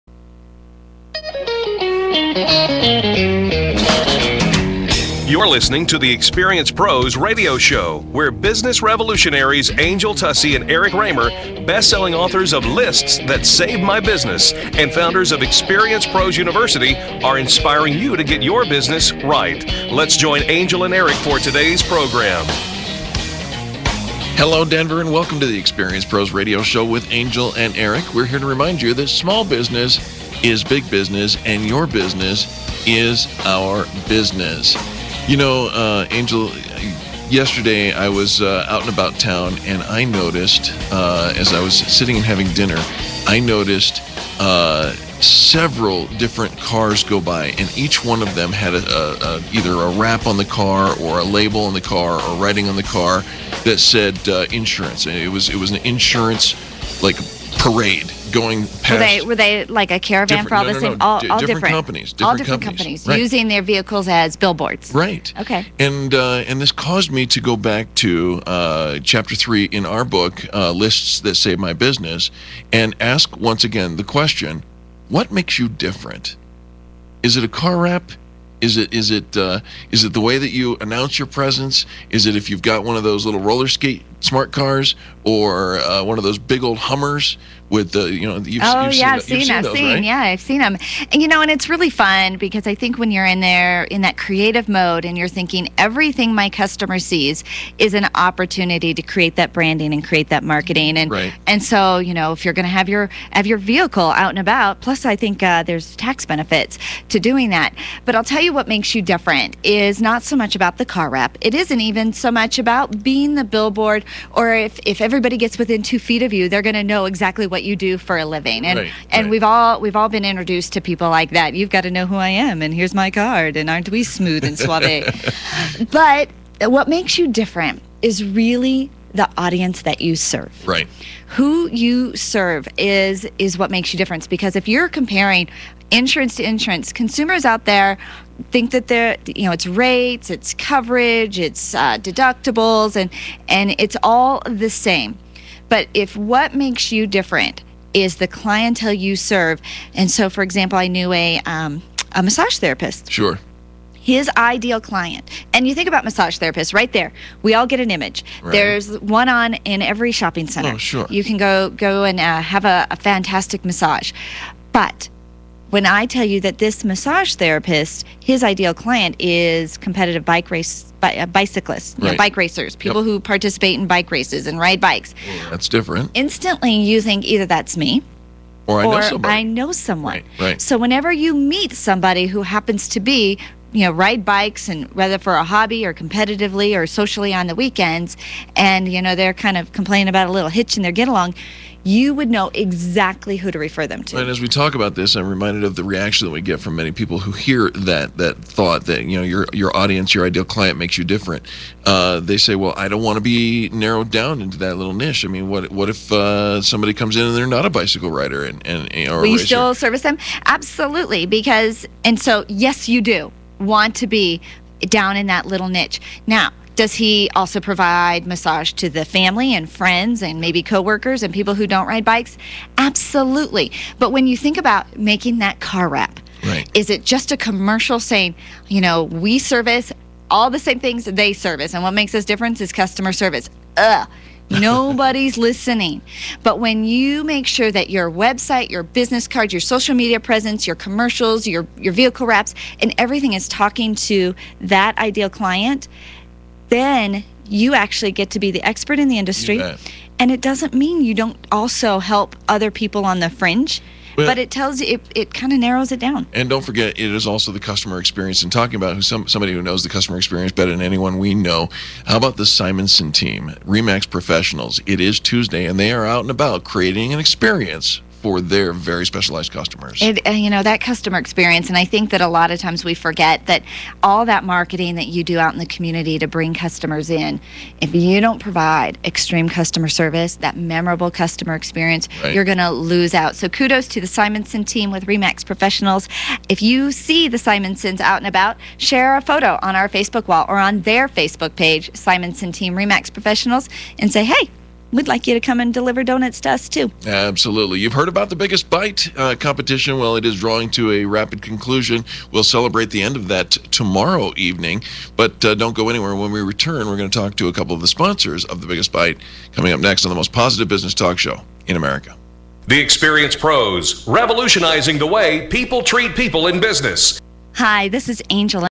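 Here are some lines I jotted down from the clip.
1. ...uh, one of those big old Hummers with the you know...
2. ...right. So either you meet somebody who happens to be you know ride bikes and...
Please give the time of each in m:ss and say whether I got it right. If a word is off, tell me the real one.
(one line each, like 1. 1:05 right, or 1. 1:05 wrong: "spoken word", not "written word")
1. 1:25 right
2. 3:00 wrong: "whenever", not "either".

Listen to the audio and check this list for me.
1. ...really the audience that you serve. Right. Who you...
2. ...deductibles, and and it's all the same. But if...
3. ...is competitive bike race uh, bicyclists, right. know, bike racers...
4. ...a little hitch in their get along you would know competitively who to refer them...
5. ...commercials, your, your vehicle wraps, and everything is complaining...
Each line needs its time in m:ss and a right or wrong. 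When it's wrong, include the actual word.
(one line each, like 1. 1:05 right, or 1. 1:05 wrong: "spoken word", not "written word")
1. 2:08 right
2. 2:21 right
3. 2:49 right
4. 3:10 wrong: "exactly", not "competitively"
5. 4:00 wrong: "talking", not "complaining".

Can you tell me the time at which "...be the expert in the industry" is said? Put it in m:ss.
4:08.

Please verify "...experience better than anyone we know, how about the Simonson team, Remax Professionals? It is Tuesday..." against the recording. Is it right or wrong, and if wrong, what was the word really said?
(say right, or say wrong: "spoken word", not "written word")
right.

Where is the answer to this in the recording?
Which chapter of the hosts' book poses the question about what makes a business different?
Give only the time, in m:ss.
1:09.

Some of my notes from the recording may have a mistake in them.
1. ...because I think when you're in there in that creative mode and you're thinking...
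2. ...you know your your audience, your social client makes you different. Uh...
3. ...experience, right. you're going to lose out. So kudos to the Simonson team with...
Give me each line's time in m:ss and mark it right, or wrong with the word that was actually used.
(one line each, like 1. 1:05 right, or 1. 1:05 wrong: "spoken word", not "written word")
1. 1:32 right
2. 3:19 wrong: "ideal", not "social"
3. 4:41 right.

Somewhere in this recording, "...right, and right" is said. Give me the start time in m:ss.
1:58.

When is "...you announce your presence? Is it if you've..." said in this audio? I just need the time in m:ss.
1:20.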